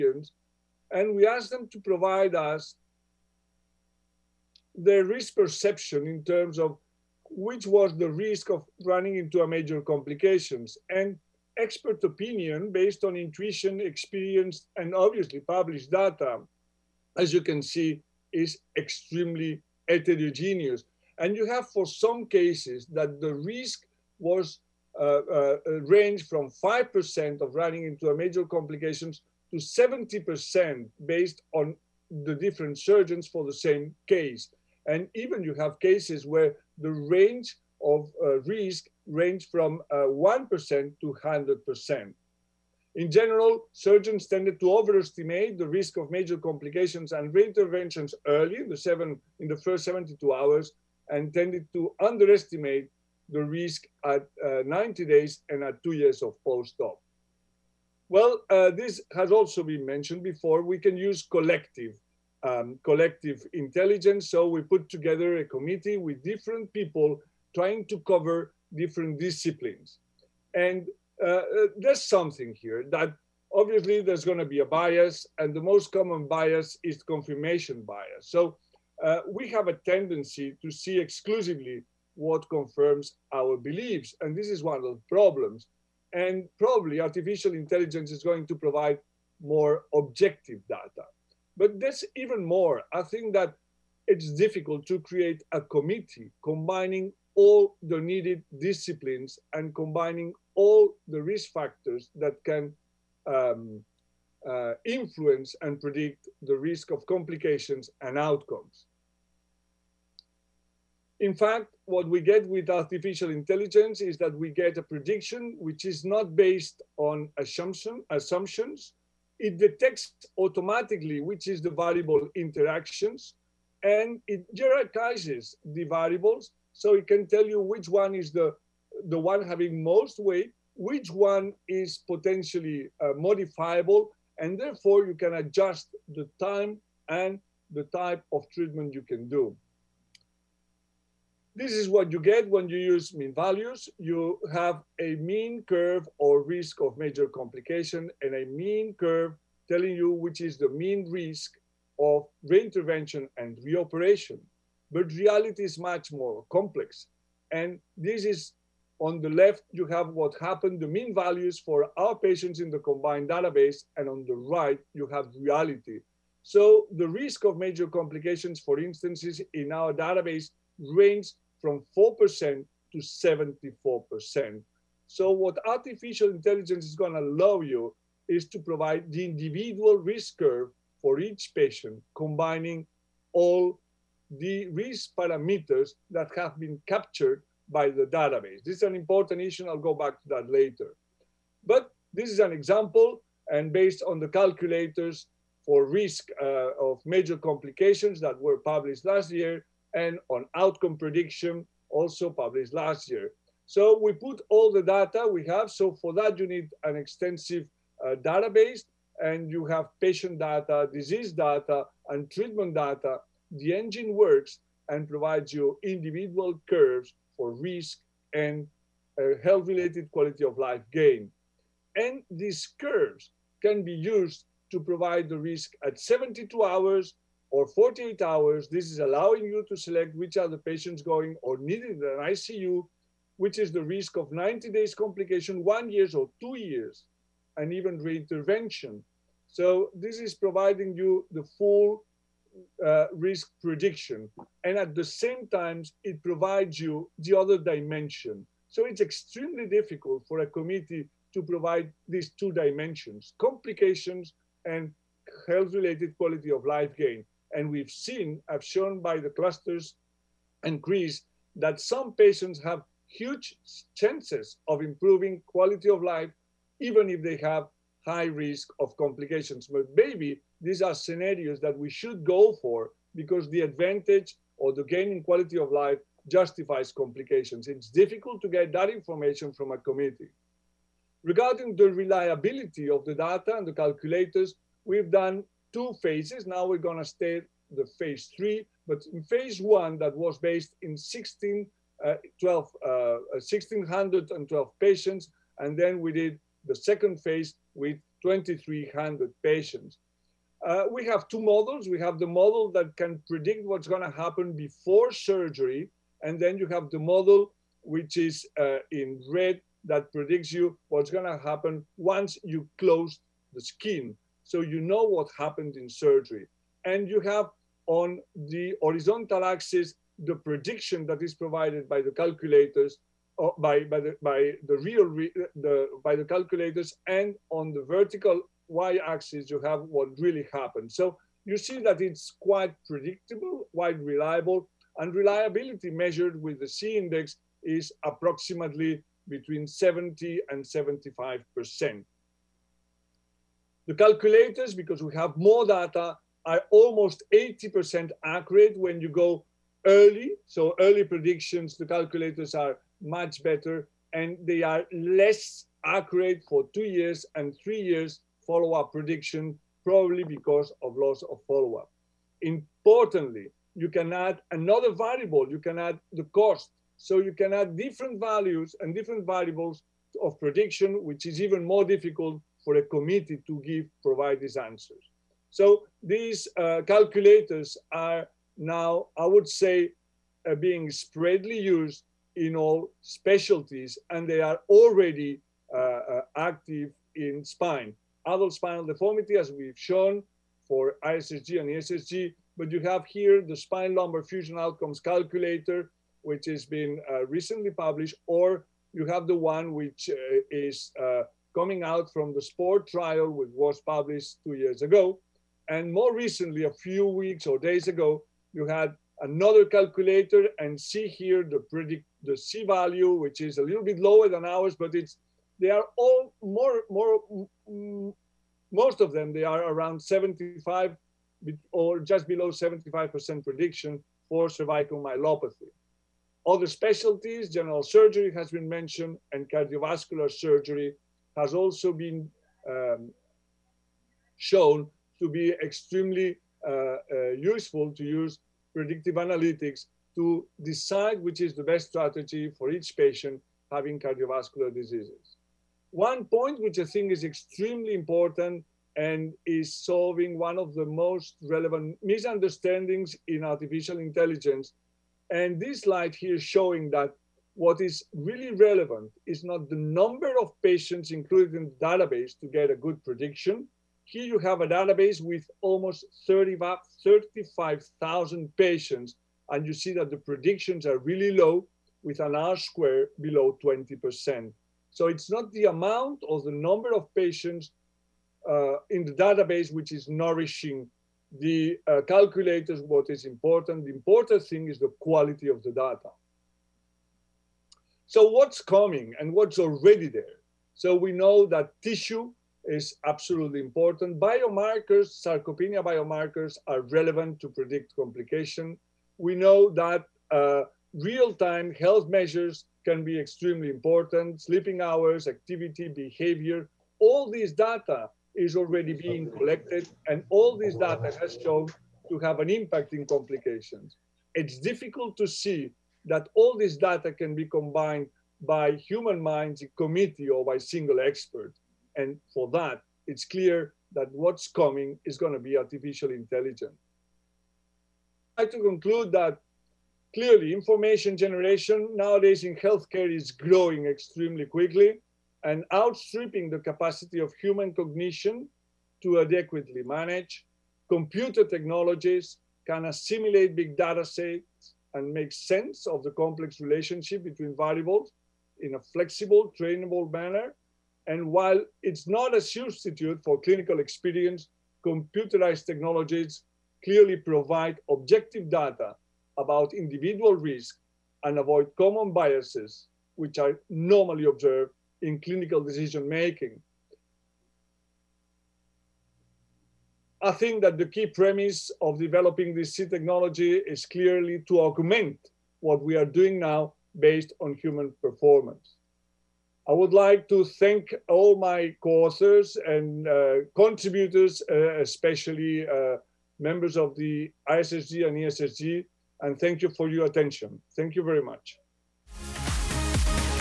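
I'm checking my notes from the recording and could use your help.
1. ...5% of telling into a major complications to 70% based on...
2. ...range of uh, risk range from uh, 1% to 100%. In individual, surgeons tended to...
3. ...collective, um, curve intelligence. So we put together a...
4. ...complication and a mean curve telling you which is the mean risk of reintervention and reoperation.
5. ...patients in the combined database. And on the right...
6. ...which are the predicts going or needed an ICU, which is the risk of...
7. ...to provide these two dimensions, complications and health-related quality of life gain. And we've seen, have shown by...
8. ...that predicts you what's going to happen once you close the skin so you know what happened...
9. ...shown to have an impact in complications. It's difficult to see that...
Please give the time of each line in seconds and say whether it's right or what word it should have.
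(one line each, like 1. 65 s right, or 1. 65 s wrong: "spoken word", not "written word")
1. 26 s wrong: "running", not "telling"
2. 36 s wrong: "general", not "individual"
3. 61 s wrong: "collective", not "curve"
4. 147 s right
5. 162 s right
6. 230 s wrong: "patients", not "predicts"
7. 251 s right
8. 309 s right
9. 511 s right.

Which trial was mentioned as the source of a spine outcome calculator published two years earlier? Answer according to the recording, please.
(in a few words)
SPORT trial.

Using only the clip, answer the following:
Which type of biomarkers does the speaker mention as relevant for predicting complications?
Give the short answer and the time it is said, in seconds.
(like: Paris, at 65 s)
Sarcopenia biomarkers, at 495 s.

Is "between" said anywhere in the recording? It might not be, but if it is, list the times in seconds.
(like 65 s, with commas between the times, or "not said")
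339 s, 547 s.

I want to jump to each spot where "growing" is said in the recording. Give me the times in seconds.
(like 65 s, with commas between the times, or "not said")
533 s.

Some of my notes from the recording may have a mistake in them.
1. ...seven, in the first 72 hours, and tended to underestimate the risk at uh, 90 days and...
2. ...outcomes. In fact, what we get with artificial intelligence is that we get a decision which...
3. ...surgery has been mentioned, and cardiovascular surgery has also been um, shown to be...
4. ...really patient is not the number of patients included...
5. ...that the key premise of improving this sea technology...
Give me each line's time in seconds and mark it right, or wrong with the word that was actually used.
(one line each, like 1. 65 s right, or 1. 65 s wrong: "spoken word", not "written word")
1. 48 s right
2. 108 s wrong: "prediction", not "decision"
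3. 427 s right
4. 458 s wrong: "relevant", not "patient"
5. 570 s wrong: "developing", not "improving".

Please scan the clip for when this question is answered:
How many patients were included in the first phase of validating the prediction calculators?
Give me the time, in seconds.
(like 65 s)
293 s.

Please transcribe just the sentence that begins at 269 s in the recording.
But maybe these are scenarios that we should go for because the advantage or the gain in quality of life justifies complications.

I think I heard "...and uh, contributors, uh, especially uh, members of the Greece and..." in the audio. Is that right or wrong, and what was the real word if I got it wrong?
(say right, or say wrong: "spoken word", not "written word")
wrong: "ISSG", not "Greece".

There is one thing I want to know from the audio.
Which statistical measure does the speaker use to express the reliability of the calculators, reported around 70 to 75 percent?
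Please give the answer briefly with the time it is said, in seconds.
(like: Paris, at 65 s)
C-index, at 336 s.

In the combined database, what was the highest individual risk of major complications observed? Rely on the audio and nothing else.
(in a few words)
74%.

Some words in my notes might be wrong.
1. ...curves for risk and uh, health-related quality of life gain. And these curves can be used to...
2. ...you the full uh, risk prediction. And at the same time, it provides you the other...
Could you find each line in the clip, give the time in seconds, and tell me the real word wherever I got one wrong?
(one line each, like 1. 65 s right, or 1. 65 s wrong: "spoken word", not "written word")
1. 216 s right
2. 240 s right.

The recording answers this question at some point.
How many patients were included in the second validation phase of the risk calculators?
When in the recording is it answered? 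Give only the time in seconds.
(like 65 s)
298 s.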